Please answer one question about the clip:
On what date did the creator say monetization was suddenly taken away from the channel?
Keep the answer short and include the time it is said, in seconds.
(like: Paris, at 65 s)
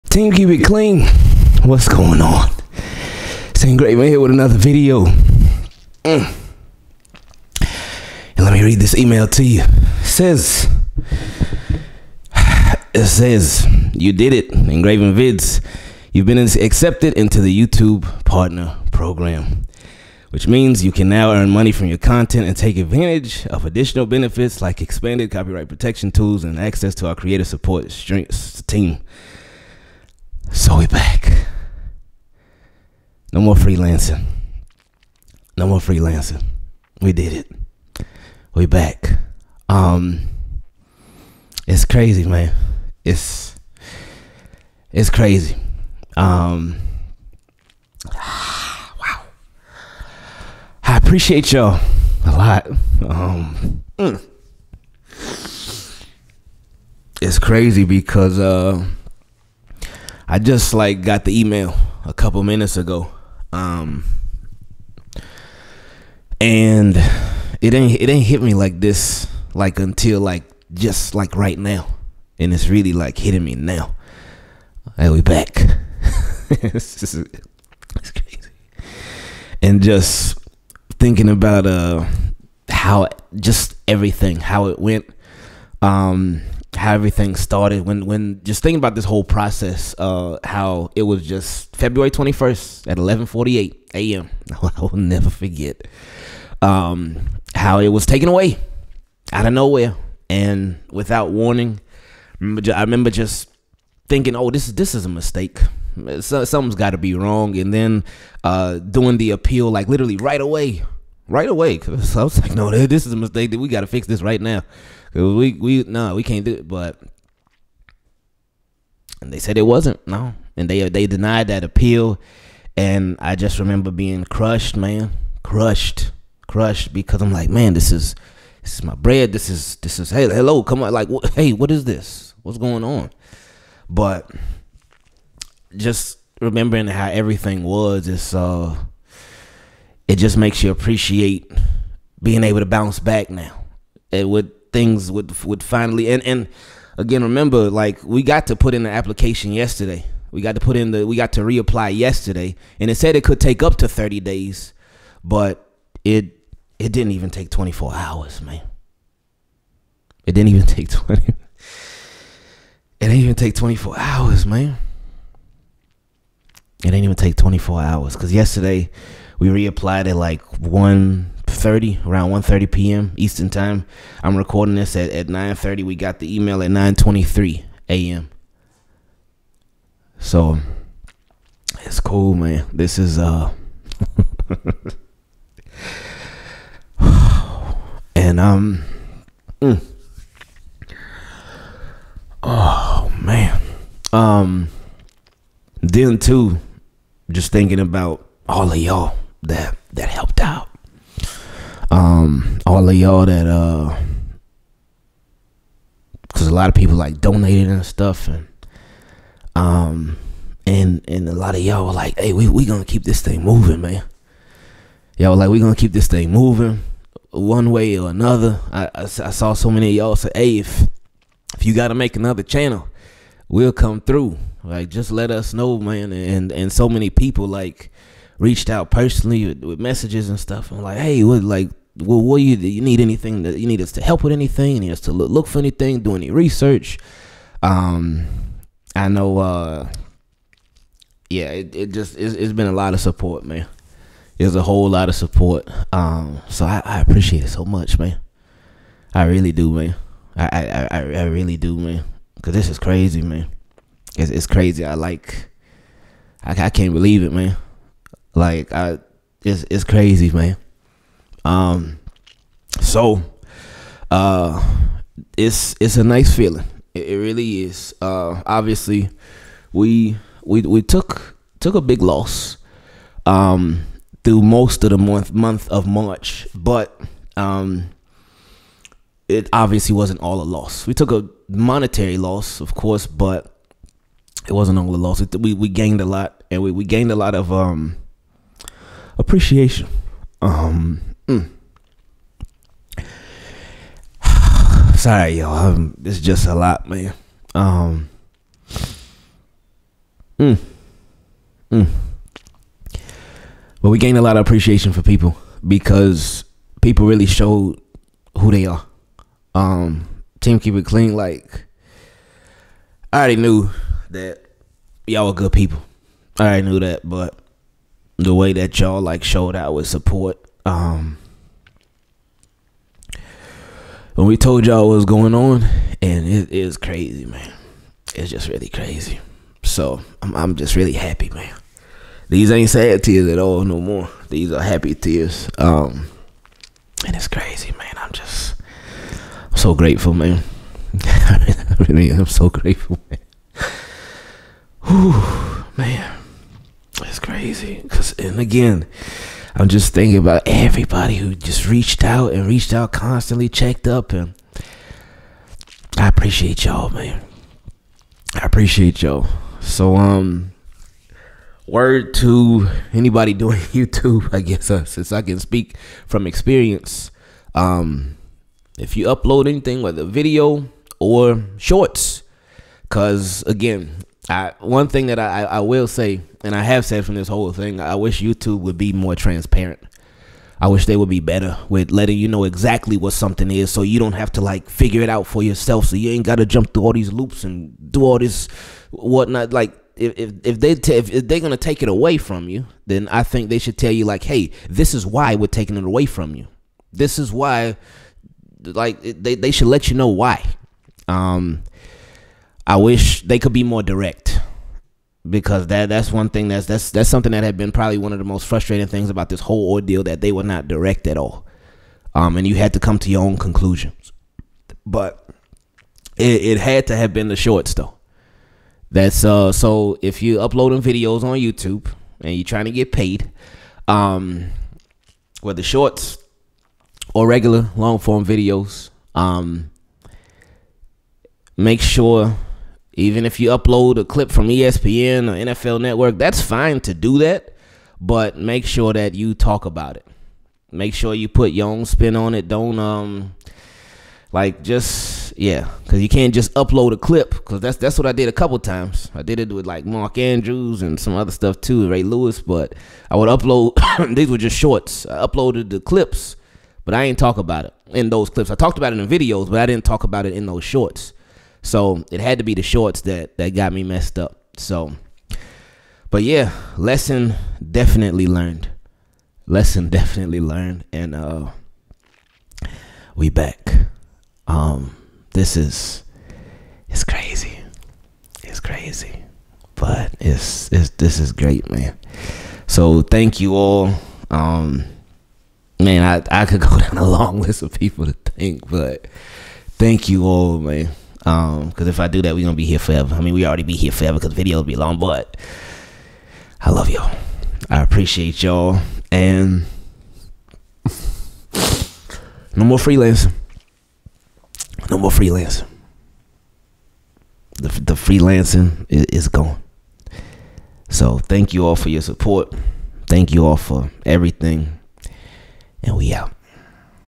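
February 21st, at 91 s.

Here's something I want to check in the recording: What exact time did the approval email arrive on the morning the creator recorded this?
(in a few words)
9:23 a.m.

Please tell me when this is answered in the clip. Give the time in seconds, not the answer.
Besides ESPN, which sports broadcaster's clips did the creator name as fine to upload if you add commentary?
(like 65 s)
435 s.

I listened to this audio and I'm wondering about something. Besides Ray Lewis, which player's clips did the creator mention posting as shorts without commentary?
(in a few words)
Mark Andrews.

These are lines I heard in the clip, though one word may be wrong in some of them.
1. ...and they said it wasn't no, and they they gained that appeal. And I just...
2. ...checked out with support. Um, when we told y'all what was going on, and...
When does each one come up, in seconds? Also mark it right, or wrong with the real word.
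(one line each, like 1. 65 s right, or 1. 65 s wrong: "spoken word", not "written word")
1. 119 s wrong: "denied", not "gained"
2. 319 s wrong: "showed", not "checked".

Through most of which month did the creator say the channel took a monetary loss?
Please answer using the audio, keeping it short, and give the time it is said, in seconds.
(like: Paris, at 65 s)
March, at 275 s.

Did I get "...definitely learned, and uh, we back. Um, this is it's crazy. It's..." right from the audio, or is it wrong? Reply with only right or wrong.
right.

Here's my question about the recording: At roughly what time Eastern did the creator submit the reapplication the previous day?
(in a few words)
1:30 p.m.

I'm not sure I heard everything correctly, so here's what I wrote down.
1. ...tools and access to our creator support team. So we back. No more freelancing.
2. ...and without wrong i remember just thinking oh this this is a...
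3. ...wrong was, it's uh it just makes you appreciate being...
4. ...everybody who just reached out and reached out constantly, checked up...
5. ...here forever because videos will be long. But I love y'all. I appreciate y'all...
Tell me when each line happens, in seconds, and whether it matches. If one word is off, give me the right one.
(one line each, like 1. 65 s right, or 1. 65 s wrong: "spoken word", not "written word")
1. 26 s right
2. 100 s wrong: "warning", not "wrong"
3. 137 s wrong: "everything", not "wrong"
4. 350 s right
5. 493 s right.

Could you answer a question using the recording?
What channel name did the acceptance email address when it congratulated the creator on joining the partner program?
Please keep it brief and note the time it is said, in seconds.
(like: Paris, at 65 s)
Ingraven Vids, at 14 s.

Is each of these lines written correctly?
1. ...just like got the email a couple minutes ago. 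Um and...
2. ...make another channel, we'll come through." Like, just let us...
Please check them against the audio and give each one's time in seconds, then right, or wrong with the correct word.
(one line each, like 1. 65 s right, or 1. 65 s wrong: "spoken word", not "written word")
1. 60 s right
2. 221 s right.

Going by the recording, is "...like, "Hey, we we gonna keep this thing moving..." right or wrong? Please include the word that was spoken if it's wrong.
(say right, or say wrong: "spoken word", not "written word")
right.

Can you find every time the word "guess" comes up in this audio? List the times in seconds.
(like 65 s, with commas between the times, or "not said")
364 s.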